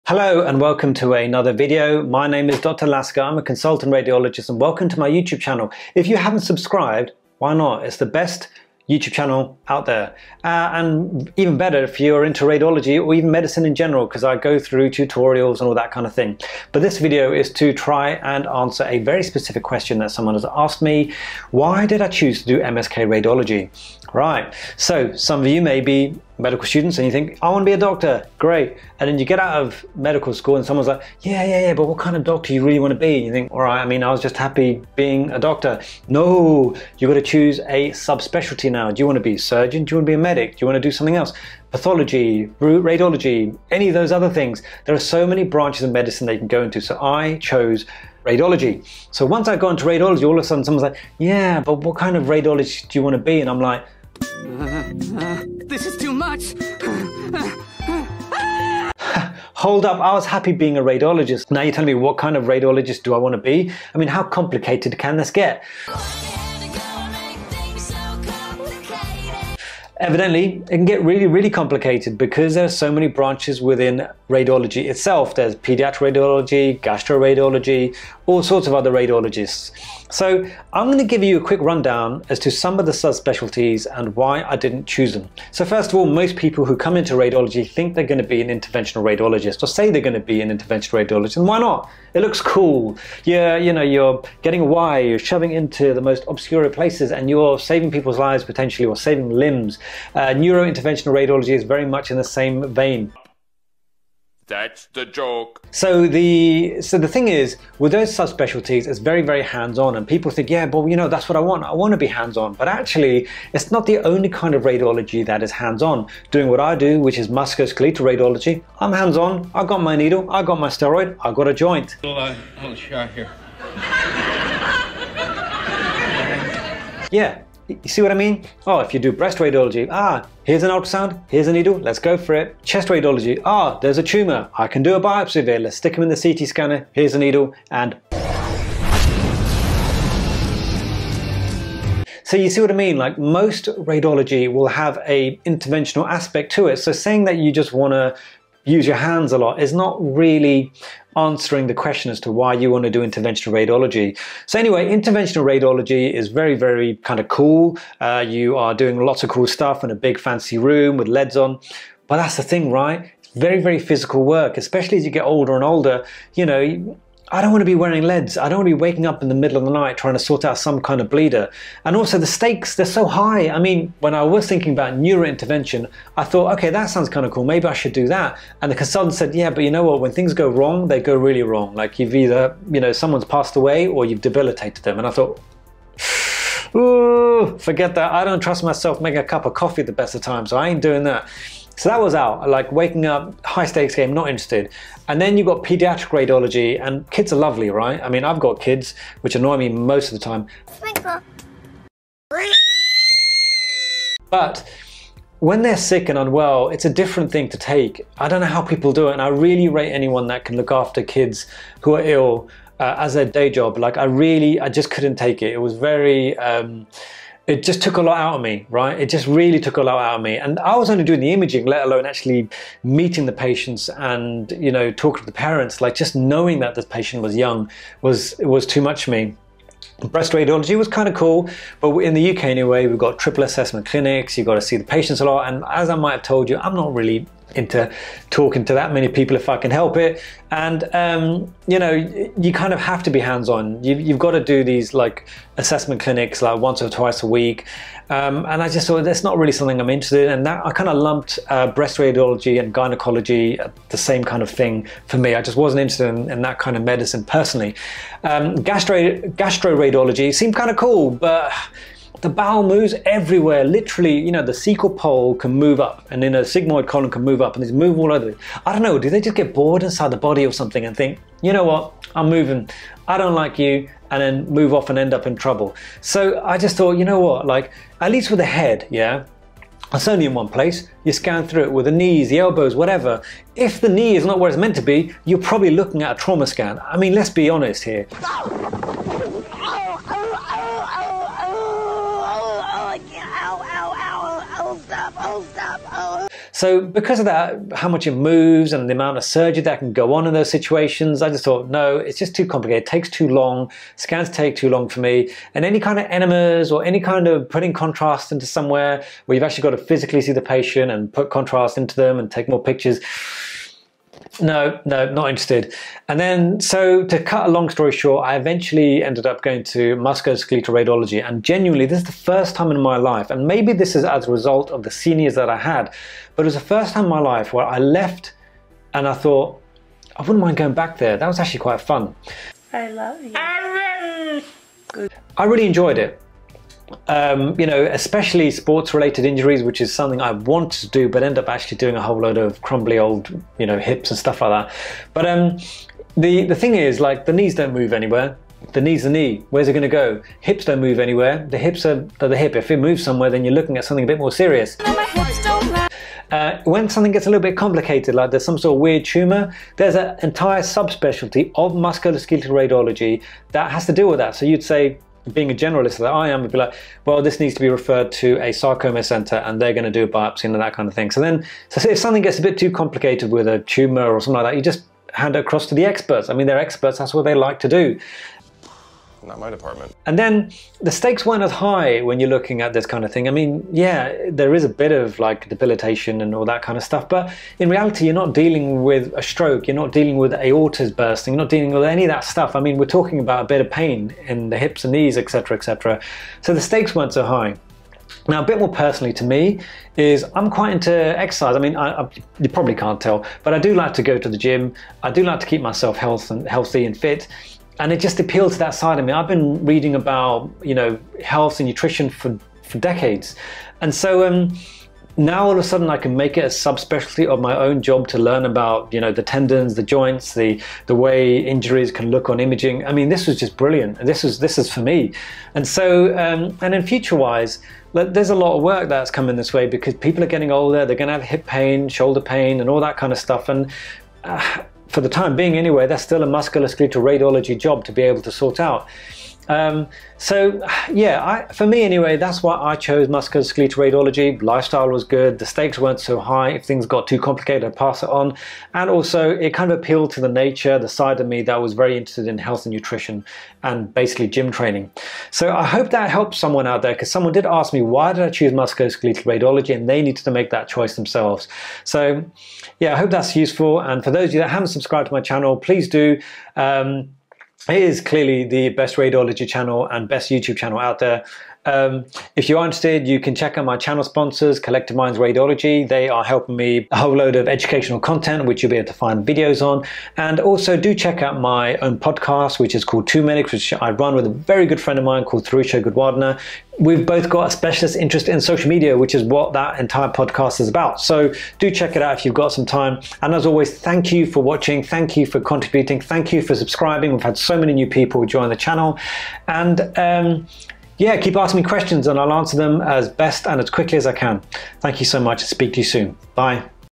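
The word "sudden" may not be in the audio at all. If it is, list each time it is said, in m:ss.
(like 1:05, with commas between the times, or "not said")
0:50, 6:55.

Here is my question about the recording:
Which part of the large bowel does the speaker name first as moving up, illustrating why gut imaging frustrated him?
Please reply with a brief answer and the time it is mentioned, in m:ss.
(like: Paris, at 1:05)
Cecal pole, at 4:24.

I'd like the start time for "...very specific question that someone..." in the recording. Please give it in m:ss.
0:18.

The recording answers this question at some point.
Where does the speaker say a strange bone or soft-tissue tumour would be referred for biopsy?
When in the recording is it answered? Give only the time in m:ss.
6:08.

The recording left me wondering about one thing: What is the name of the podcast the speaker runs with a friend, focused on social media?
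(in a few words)
Two Medics.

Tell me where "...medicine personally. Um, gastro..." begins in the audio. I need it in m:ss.
4:16.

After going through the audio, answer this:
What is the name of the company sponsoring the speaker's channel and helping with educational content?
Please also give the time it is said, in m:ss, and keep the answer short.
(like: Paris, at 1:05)
Collective Minds Radiology, at 7:54.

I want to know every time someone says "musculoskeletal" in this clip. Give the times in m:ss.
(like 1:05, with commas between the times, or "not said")
1:57, 5:19, 6:01, 7:16, 7:23, 7:38.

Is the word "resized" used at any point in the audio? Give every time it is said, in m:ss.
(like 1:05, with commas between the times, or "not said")
not said.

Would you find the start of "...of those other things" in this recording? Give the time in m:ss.
0:43.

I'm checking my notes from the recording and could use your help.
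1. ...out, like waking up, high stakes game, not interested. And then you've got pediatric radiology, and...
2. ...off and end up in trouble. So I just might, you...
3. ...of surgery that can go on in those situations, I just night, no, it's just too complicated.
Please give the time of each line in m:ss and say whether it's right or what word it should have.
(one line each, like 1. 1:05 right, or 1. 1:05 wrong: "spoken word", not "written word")
1. 3:12 right
2. 4:34 wrong: "thought", not "might"
3. 4:59 wrong: "thought", not "night".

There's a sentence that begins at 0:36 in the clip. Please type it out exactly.
No, you got to choose a subspecialty now.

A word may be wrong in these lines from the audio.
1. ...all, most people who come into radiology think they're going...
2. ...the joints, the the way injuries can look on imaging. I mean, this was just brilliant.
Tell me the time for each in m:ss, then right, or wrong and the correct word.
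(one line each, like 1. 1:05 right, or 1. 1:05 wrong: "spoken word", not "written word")
1. 1:25 right
2. 6:59 right.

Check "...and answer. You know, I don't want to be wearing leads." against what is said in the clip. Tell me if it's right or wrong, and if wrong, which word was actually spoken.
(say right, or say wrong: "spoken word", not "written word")
wrong: "older", not "answer".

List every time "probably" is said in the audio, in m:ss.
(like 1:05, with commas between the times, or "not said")
4:45, 6:42.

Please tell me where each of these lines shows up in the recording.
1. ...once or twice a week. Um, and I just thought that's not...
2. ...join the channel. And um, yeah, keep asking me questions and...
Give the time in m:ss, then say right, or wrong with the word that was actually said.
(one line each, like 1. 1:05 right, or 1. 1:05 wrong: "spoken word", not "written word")
1. 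4:06 right
2. 8:18 right.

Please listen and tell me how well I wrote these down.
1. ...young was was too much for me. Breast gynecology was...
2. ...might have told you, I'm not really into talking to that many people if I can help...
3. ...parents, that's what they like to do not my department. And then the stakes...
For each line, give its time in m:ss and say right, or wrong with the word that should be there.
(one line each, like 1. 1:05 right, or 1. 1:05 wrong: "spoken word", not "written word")
1. 3:47 wrong: "radiology", not "gynecology"
2. 3:55 right
3. 6:16 wrong: "experts", not "parents".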